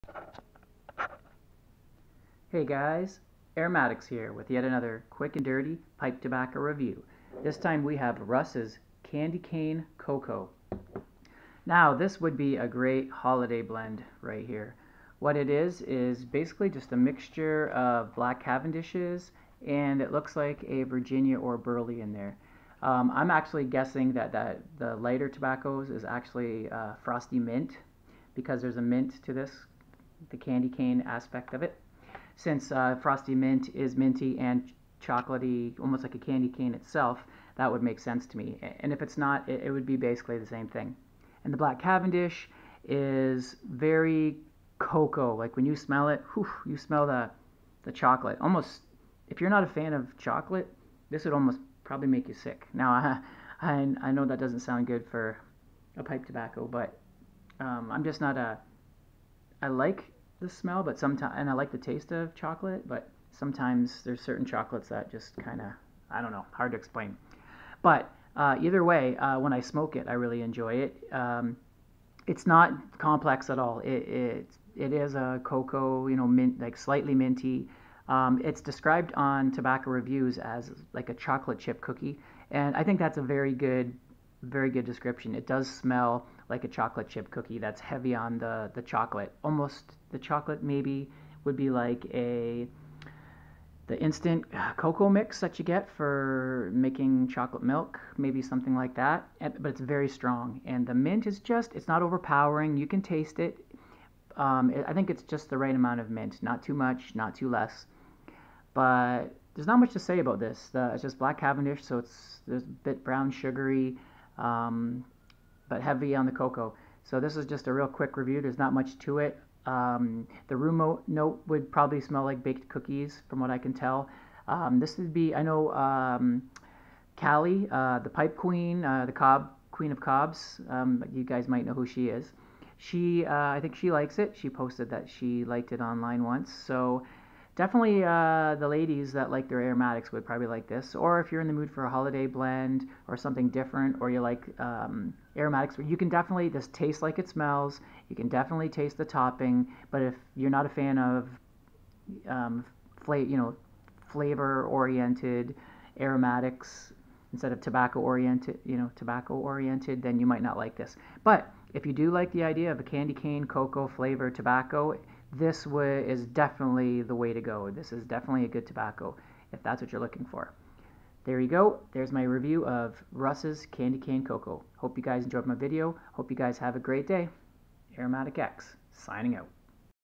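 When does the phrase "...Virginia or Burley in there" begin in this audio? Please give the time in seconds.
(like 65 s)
20 s.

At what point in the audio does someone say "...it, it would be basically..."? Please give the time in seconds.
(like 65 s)
39 s.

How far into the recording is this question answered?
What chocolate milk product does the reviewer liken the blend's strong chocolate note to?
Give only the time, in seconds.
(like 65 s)
93 s.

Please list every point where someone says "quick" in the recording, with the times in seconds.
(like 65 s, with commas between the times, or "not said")
5 s, 117 s.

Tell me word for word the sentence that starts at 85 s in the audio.
It does smell like a chocolate chip cookie that's heavy on the, the chocolate.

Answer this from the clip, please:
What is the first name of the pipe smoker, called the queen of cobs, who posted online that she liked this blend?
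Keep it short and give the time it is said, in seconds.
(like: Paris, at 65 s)
Callie, at 127 s.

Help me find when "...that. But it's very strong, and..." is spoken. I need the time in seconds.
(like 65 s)
98 s.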